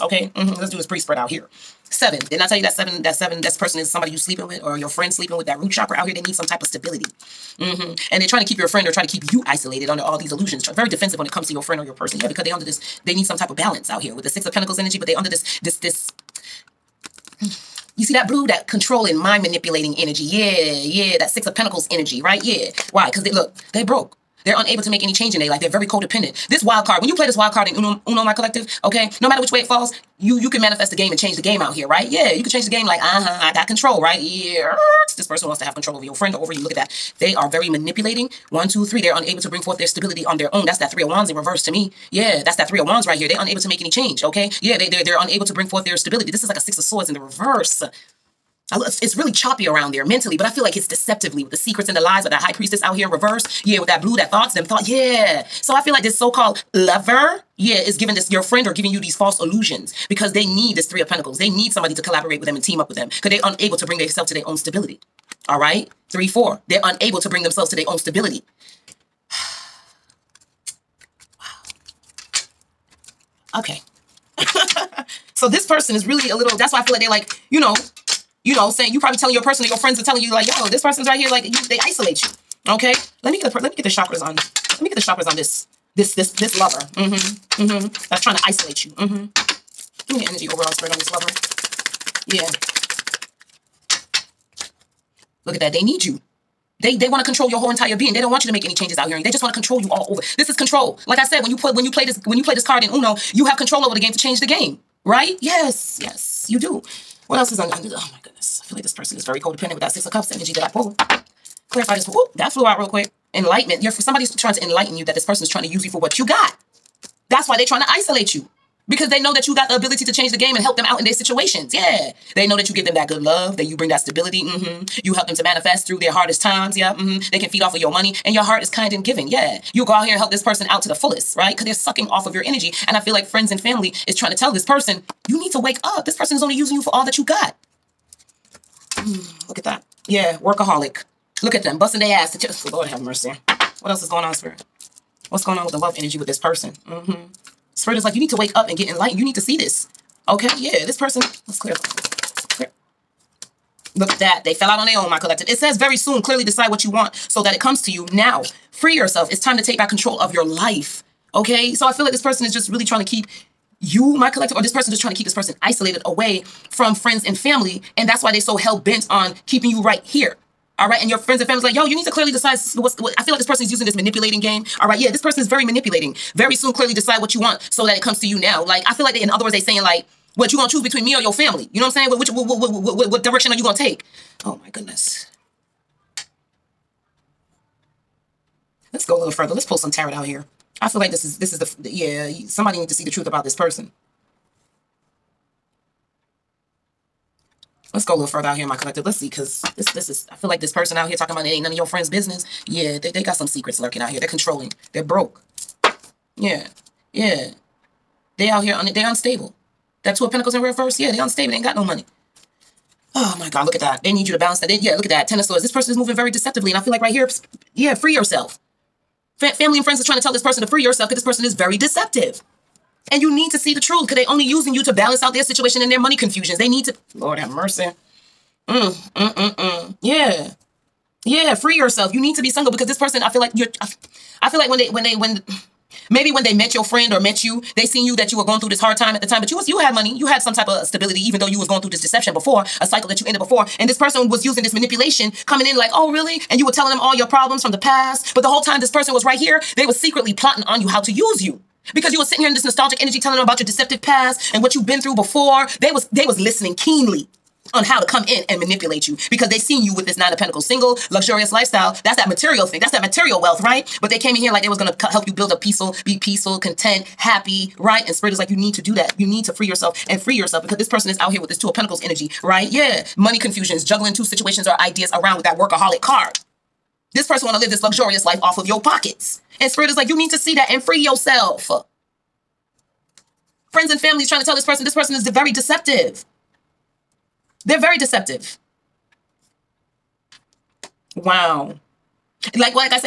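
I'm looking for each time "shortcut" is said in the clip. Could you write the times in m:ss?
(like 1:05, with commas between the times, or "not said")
not said.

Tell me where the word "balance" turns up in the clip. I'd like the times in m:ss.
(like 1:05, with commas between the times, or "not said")
0:13, 3:34, 3:44.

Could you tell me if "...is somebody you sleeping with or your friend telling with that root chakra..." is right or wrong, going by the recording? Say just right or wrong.
wrong.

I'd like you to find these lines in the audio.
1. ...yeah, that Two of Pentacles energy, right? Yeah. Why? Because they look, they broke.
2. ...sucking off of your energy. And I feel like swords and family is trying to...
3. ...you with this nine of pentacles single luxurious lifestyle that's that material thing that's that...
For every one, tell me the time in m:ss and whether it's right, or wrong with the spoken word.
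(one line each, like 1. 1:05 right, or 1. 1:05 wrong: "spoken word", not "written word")
1. 0:21 wrong: "Six", not "Two"
2. 2:11 wrong: "friends", not "swords"
3. 4:19 right.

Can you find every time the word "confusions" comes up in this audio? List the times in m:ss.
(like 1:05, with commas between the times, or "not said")
3:46, 4:33.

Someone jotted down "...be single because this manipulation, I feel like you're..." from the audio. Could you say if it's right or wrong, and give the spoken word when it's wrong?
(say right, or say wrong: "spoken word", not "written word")
wrong: "person", not "manipulation".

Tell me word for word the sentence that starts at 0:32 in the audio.
Yeah, you could change the game like, uh-huh, I got control, right?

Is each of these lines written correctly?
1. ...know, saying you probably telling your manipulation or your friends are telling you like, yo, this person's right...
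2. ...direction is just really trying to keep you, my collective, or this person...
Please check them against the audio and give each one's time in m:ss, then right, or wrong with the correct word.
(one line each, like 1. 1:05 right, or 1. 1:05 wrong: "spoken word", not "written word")
1. 1:18 wrong: "person", not "manipulation"
2. 2:42 wrong: "person", not "direction".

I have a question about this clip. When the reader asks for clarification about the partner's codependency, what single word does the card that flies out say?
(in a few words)
Enlightenment.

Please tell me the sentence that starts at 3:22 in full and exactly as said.
Yeah, they, they got some secrets lurking out here.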